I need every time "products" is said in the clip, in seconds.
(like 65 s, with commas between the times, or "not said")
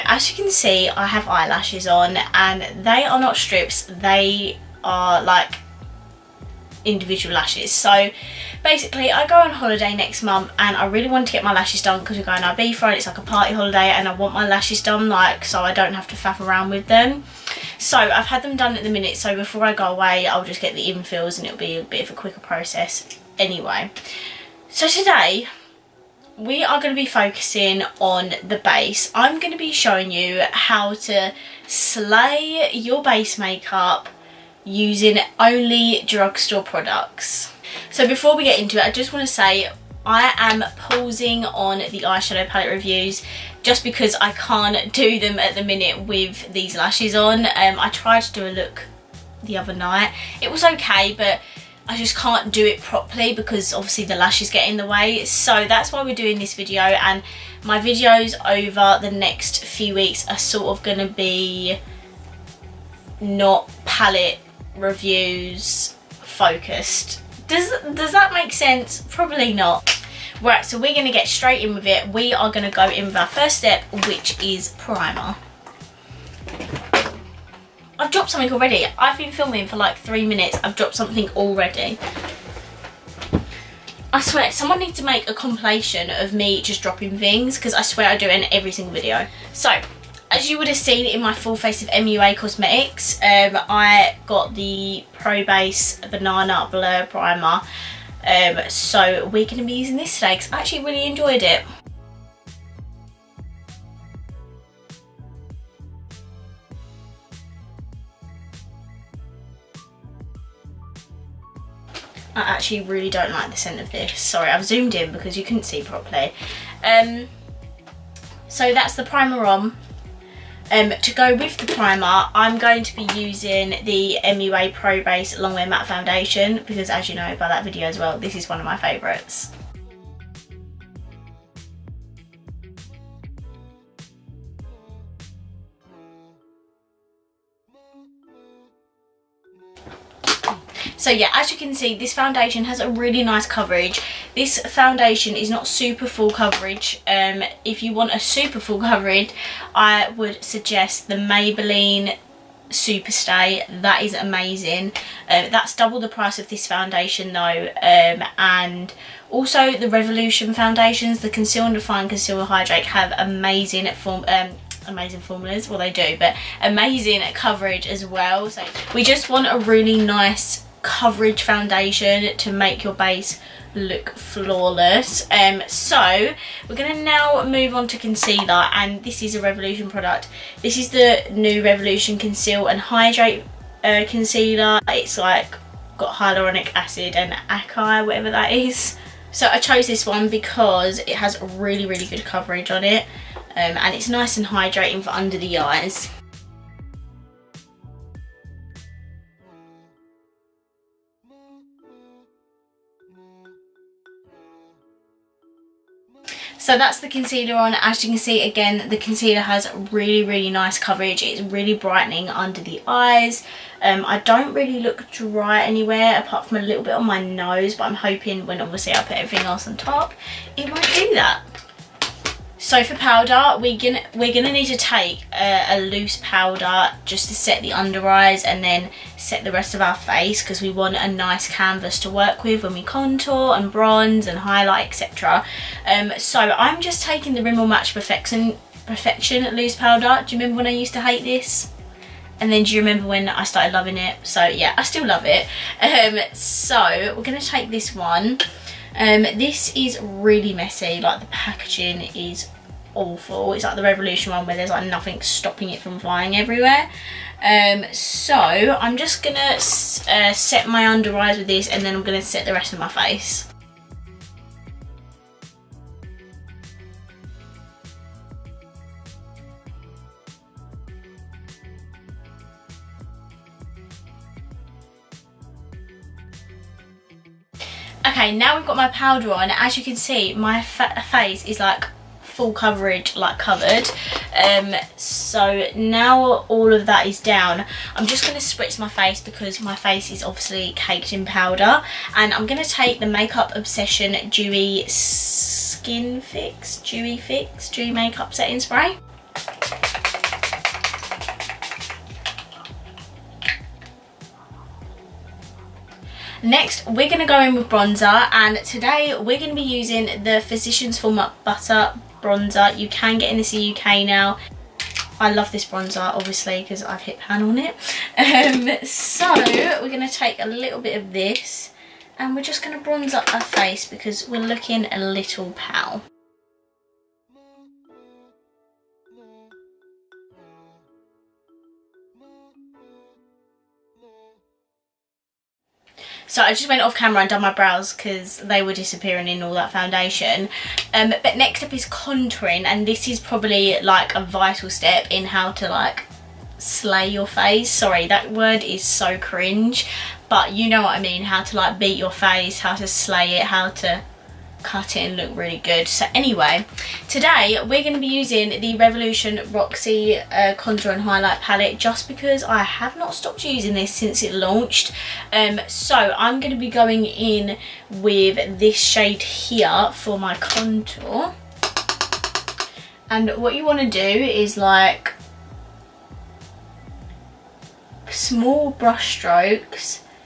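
36 s, 179 s.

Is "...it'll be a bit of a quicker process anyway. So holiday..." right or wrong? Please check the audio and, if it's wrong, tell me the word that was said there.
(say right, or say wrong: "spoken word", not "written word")
wrong: "today", not "holiday".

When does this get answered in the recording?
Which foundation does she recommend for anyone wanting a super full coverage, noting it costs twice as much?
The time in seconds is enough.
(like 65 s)
151 s.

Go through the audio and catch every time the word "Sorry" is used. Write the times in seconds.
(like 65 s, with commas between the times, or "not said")
114 s, 347 s.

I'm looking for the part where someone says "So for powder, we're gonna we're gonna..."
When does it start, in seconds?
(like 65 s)
222 s.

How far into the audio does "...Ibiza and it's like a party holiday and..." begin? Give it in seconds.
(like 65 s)
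12 s.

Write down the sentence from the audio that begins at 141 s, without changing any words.
So yeah, as you can see, this foundation has a really nice coverage.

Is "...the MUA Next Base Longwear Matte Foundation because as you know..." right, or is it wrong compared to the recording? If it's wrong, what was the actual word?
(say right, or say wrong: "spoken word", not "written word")
wrong: "Pro", not "Next".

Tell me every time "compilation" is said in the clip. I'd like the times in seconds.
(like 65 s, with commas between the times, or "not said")
85 s.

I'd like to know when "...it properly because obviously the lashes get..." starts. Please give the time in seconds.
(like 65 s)
52 s.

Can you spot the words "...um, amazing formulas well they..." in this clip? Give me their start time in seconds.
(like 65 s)
164 s.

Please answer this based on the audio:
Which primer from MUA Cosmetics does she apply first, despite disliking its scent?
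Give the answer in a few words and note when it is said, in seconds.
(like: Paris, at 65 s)
Pro Base Banana Blur Primer, at 95 s.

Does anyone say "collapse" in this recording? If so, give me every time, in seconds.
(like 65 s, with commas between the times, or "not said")
not said.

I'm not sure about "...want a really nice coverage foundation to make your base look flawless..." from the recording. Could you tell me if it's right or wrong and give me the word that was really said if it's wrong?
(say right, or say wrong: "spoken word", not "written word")
right.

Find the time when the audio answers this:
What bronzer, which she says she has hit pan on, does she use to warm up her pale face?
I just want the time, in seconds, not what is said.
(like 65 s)
310 s.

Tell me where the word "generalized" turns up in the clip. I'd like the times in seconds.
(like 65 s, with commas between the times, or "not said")
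not said.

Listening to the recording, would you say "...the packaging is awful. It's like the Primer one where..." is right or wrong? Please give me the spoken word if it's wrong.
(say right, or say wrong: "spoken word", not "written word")
wrong: "Revolution", not "Primer".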